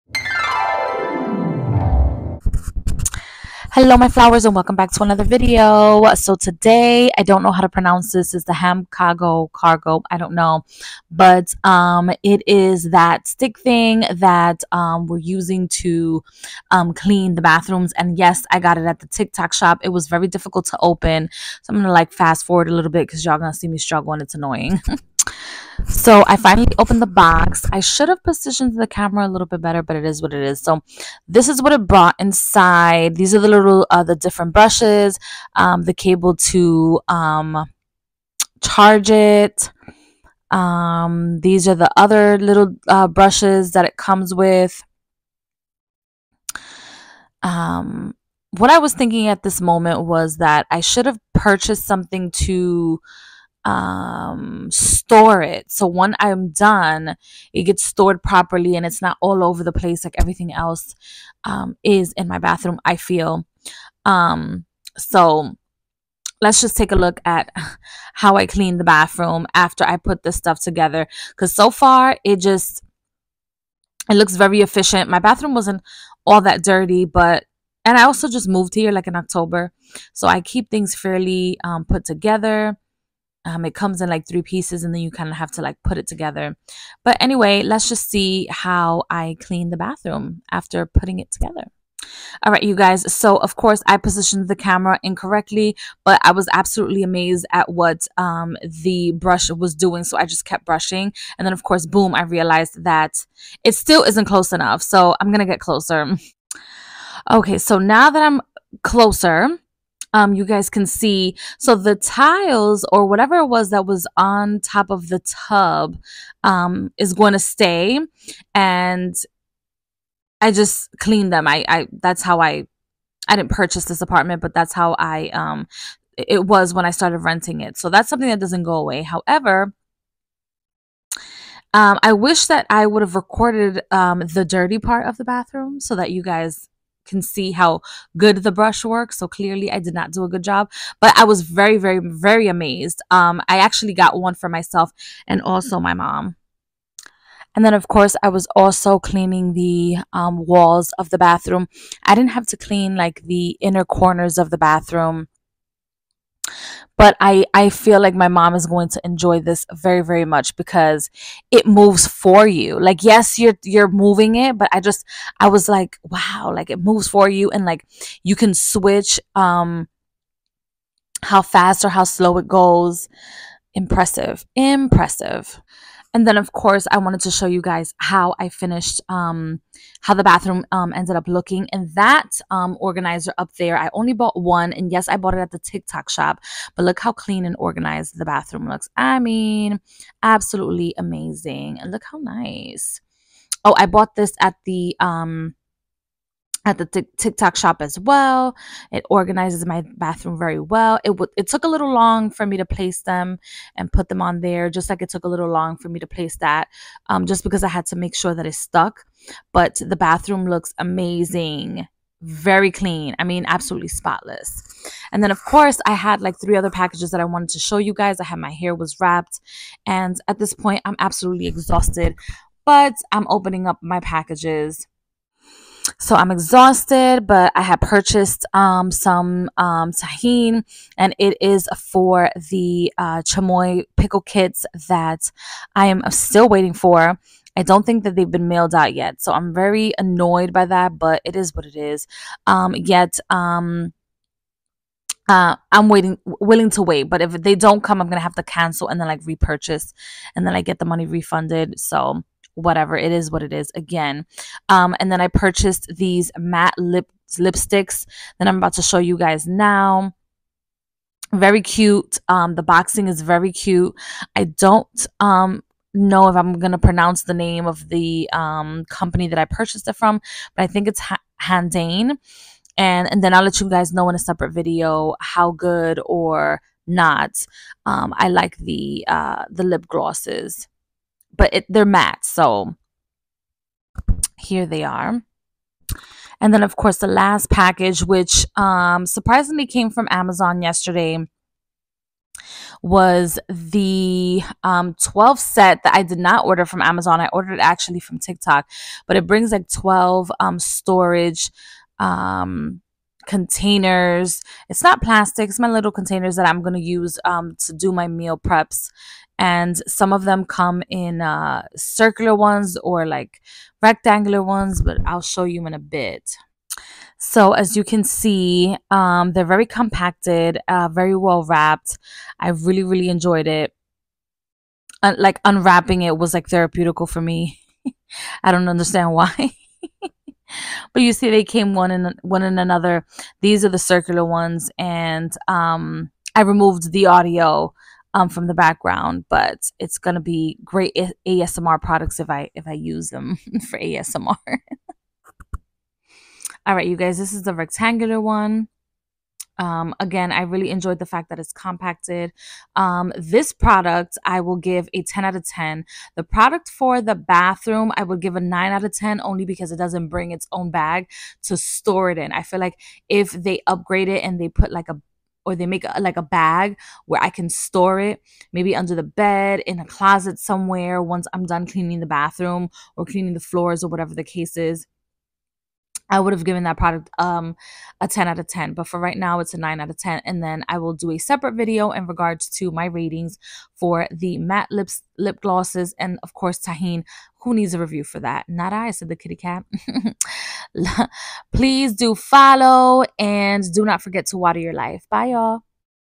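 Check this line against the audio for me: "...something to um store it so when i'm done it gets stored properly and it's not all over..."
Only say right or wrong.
right.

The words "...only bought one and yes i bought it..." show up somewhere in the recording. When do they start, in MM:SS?
03:03.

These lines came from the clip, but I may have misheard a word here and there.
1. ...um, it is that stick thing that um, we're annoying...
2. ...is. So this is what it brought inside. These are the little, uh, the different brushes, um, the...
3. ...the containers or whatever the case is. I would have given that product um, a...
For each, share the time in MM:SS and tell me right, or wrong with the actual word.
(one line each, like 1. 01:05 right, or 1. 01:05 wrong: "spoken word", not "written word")
1. 00:11 wrong: "using", not "annoying"
2. 00:30 right
3. 06:13 wrong: "floors", not "containers".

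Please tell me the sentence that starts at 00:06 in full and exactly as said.
So today, I don't know how to pronounce this.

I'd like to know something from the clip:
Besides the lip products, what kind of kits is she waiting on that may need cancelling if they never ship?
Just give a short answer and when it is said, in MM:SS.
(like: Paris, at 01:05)
Chamoy pickle kits, at 03:53.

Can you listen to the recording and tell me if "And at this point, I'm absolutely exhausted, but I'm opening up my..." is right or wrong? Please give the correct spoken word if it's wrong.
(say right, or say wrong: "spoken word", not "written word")
right.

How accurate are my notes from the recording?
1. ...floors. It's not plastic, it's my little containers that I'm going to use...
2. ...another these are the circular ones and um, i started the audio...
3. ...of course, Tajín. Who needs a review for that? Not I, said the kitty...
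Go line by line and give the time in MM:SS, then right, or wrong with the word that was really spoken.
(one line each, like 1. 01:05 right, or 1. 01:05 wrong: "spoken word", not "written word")
1. 05:03 wrong: "containers", not "floors"
2. 05:32 wrong: "removed", not "started"
3. 06:26 right.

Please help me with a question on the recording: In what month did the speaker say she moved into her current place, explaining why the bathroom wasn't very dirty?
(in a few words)
October.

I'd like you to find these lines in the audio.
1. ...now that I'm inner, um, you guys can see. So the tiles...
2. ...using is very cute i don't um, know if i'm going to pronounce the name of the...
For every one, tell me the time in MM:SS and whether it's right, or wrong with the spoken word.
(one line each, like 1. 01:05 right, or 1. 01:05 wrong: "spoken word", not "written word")
1. 01:47 wrong: "closer", not "inner"
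2. 04:22 wrong: "boxing", not "using".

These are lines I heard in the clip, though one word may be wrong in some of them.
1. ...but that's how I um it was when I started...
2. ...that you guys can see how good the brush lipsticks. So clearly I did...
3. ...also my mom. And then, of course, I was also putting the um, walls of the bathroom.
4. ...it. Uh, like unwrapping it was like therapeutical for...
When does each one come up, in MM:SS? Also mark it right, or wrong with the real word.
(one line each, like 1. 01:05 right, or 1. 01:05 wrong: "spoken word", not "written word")
1. 02:04 right
2. 02:15 wrong: "works", not "lipsticks"
3. 02:25 wrong: "cleaning", not "putting"
4. 05:23 right.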